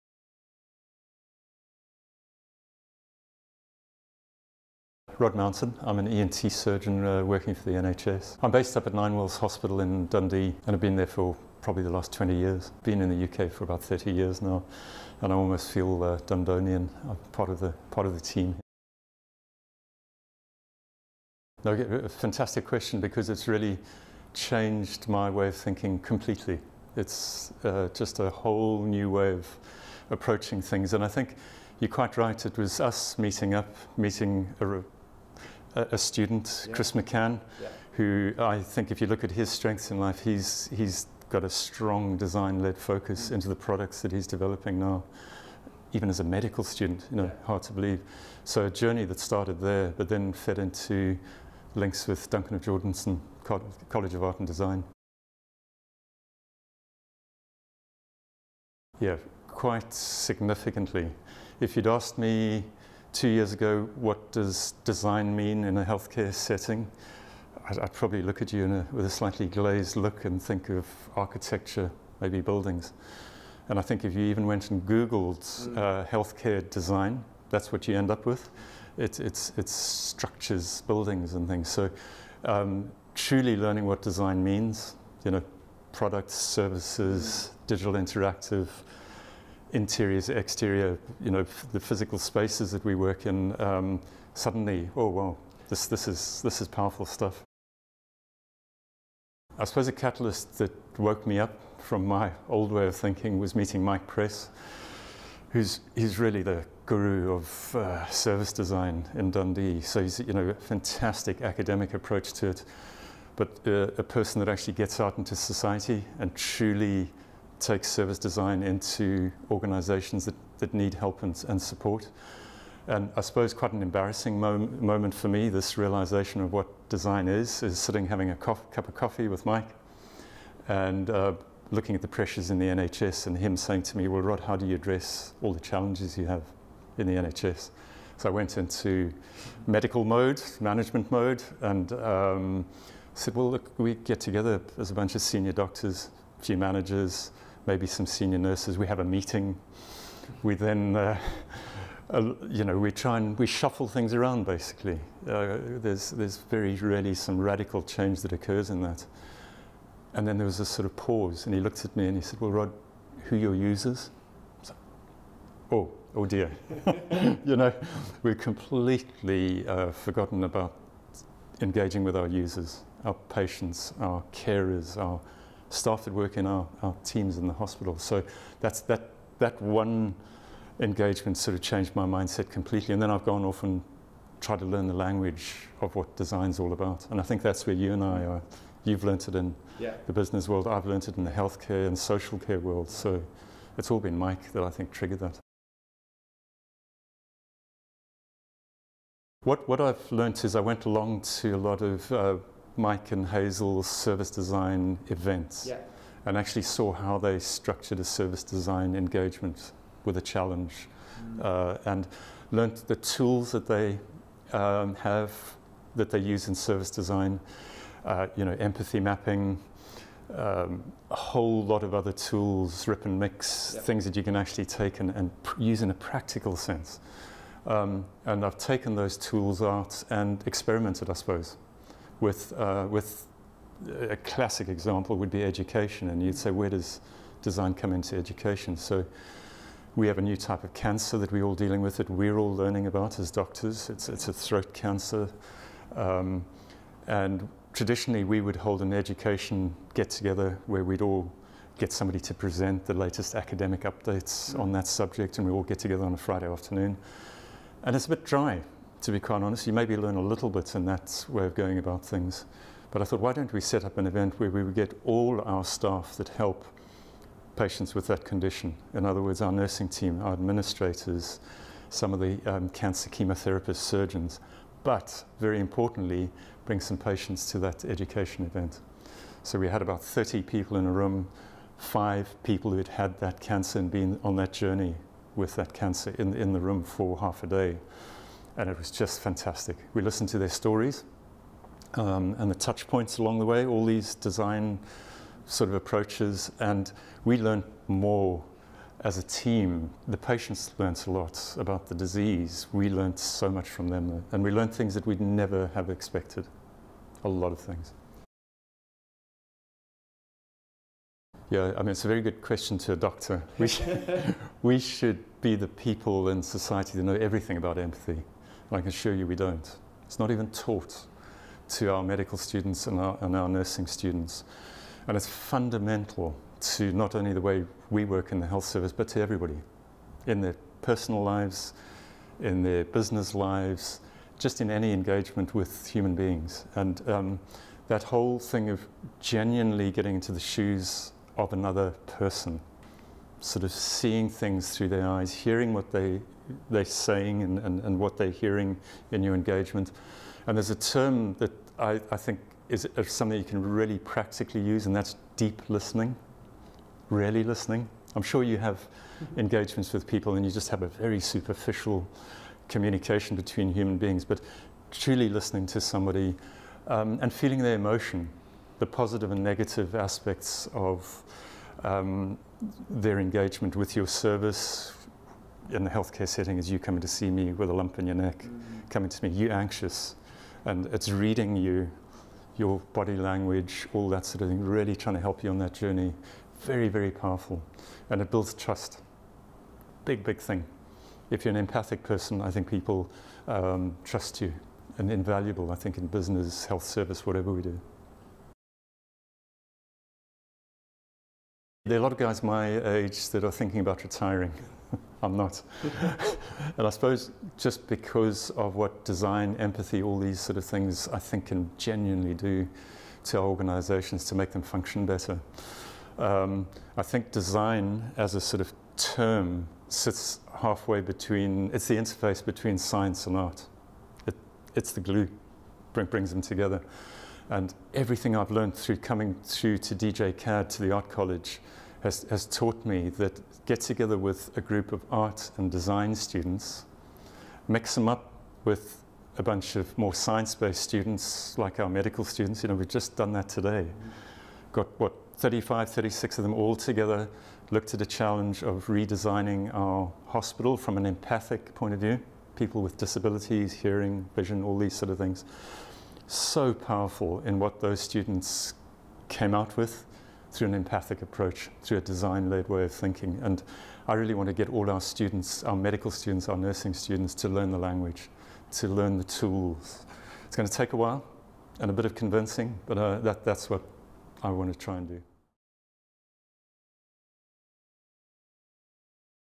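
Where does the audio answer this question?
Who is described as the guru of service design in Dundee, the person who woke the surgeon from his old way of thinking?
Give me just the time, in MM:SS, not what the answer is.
01:43.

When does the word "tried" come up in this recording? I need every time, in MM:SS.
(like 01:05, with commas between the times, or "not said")
03:04.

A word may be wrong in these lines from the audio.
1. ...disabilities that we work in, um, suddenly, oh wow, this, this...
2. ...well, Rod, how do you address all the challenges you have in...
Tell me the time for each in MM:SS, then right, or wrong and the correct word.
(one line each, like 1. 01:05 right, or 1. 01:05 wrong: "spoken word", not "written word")
1. 01:32 wrong: "spaces", not "disabilities"
2. 02:14 right.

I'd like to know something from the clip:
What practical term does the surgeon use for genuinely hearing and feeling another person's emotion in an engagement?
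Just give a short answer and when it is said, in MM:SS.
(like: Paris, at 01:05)
deep listening, at 05:55.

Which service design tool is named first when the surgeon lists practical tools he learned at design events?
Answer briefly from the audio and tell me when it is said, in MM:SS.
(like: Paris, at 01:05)
empathy mapping, at 03:38.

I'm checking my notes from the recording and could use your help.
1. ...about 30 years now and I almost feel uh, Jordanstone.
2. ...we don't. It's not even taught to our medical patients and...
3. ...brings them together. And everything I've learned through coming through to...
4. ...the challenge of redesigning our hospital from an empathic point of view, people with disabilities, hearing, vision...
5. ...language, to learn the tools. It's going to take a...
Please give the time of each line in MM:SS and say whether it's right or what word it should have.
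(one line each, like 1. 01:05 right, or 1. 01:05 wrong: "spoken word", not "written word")
1. 00:13 wrong: "Dundonian", not "Jordanstone"
2. 05:19 wrong: "students", not "patients"
3. 07:06 right
4. 07:27 right
5. 07:47 right.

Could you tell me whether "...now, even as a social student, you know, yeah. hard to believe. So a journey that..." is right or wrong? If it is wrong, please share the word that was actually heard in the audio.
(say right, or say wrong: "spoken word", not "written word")
wrong: "medical", not "social".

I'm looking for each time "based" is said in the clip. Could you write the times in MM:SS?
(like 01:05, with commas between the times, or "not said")
00:08, 07:20.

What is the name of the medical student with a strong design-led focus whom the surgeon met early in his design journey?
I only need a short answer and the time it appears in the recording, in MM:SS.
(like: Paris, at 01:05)
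Chris McCann, at 00:36.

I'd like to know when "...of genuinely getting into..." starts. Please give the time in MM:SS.
05:38.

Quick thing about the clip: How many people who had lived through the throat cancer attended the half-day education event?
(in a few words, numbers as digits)
5.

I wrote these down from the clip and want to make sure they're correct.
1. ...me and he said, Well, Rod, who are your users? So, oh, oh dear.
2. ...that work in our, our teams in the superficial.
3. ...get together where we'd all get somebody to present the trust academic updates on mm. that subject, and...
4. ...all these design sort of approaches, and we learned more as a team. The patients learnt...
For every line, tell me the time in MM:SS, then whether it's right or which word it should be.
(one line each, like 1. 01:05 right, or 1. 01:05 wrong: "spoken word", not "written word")
1. 02:41 right
2. 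02:56 wrong: "hospital", not "superficial"
3. 04:09 wrong: "latest", not "trust"
4. 04:53 right.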